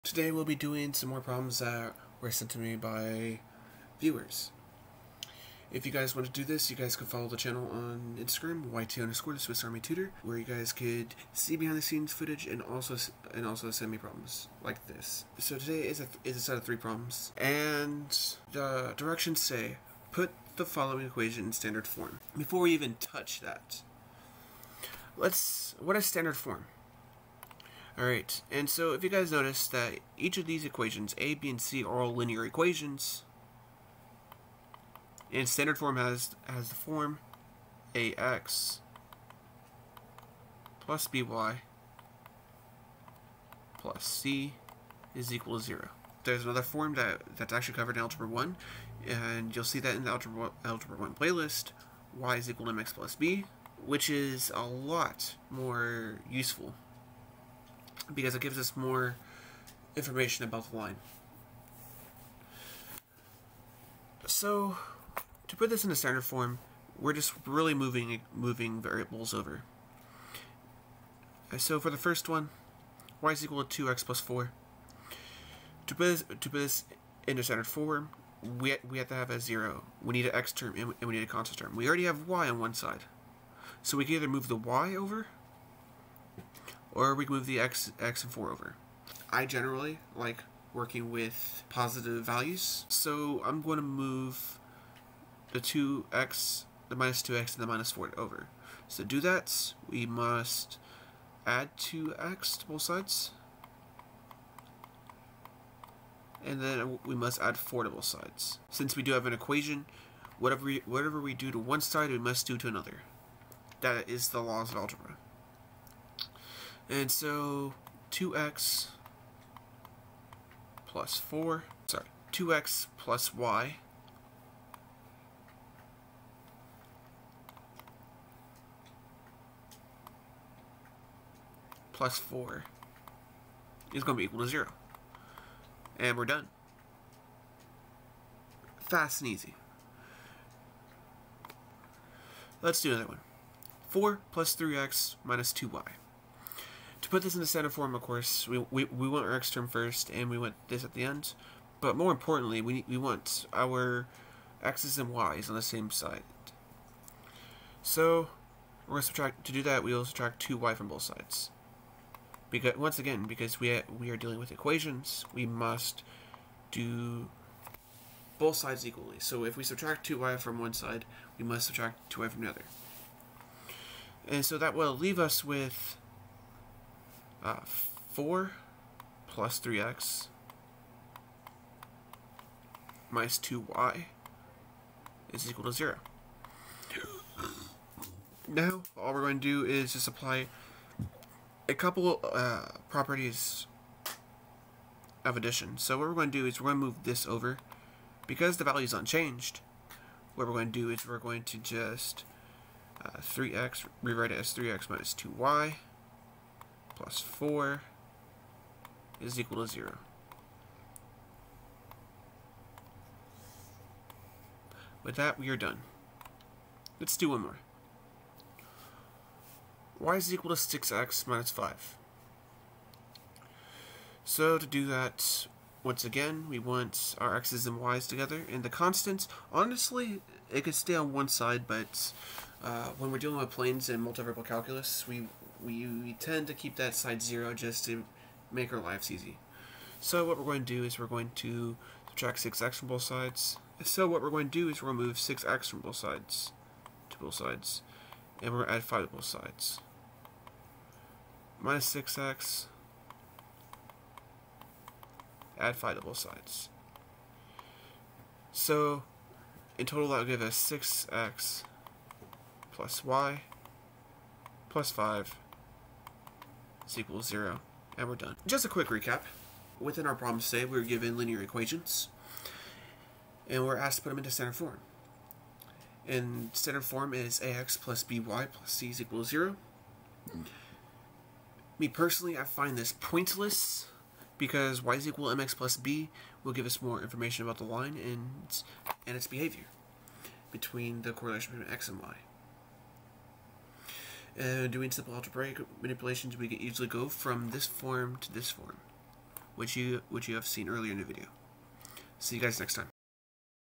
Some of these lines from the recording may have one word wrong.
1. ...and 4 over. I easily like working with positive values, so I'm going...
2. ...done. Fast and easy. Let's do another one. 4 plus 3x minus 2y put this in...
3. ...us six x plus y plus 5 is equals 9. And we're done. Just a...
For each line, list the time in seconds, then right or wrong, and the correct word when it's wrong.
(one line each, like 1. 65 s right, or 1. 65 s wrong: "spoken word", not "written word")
1. 88 s wrong: "generally", not "easily"
2. 136 s right
3. 260 s wrong: "0", not "9".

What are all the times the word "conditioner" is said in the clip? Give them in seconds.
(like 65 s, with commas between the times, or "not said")
not said.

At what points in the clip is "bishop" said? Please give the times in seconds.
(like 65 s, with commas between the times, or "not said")
not said.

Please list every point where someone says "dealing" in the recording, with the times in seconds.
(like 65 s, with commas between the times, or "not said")
164 s, 233 s.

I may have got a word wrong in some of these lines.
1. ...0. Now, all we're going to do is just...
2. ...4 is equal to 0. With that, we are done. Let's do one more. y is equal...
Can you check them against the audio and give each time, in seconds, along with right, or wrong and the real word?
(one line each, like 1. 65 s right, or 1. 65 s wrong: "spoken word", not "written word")
1. 185 s right
2. 207 s right.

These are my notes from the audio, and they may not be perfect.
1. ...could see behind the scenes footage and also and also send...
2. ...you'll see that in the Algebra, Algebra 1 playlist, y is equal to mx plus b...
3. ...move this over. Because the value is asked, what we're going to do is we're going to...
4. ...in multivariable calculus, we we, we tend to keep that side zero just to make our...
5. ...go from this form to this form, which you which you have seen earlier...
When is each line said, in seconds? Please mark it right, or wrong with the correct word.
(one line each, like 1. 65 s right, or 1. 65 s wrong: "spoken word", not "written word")
1. 10 s right
2. 49 s right
3. 196 s wrong: "unchanged", not "asked"
4. 233 s right
5. 296 s right.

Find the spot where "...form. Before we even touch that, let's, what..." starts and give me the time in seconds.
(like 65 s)
21 s.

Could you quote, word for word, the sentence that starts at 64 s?
So, to put this in a standard form, we're just really moving moving variables over.